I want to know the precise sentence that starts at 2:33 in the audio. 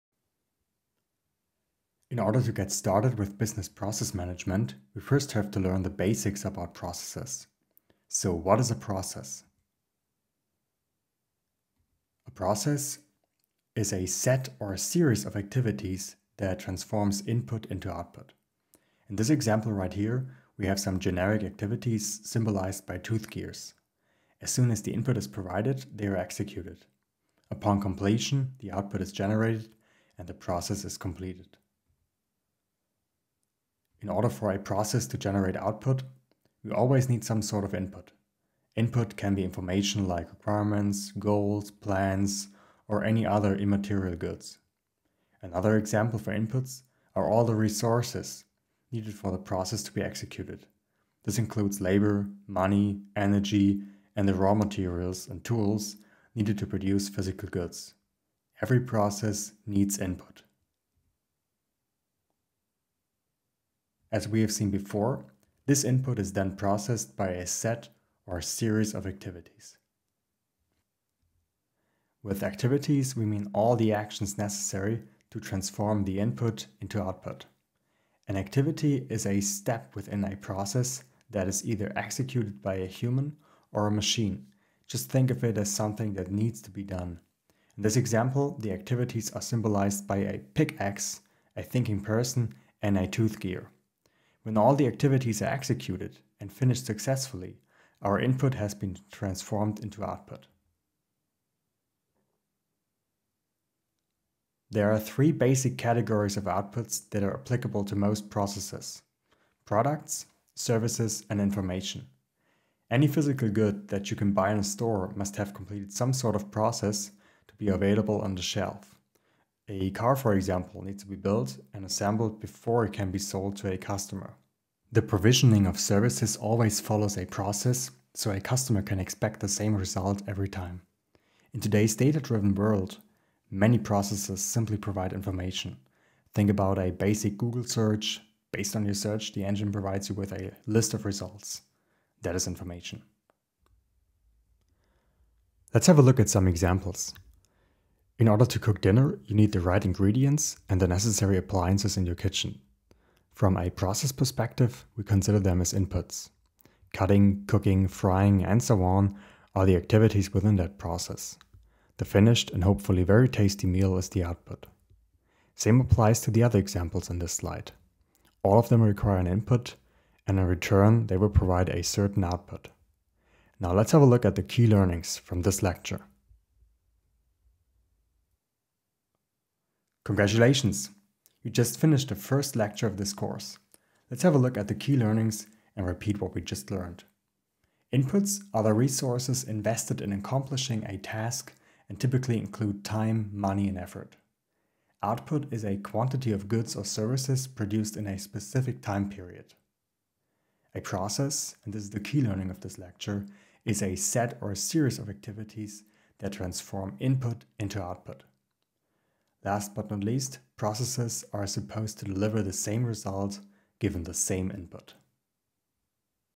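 From a process perspective, we consider them as inputs.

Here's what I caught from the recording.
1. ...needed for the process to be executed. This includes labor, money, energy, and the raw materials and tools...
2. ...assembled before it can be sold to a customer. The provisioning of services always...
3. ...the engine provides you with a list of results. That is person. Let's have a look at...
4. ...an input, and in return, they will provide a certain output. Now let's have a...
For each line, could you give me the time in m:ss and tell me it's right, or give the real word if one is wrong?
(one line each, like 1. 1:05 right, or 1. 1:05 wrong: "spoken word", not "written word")
1. 0:48 right
2. 2:01 right
3. 2:19 wrong: "information", not "person"
4. 2:49 right.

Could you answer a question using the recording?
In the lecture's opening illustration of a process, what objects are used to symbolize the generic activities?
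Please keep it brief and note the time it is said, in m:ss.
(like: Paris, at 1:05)
Tooth gears, at 0:22.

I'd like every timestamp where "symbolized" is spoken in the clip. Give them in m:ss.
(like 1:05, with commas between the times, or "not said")
0:22, 1:29.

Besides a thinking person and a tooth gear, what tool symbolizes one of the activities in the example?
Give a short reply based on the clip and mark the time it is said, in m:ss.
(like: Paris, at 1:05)
Pickaxe, at 1:30.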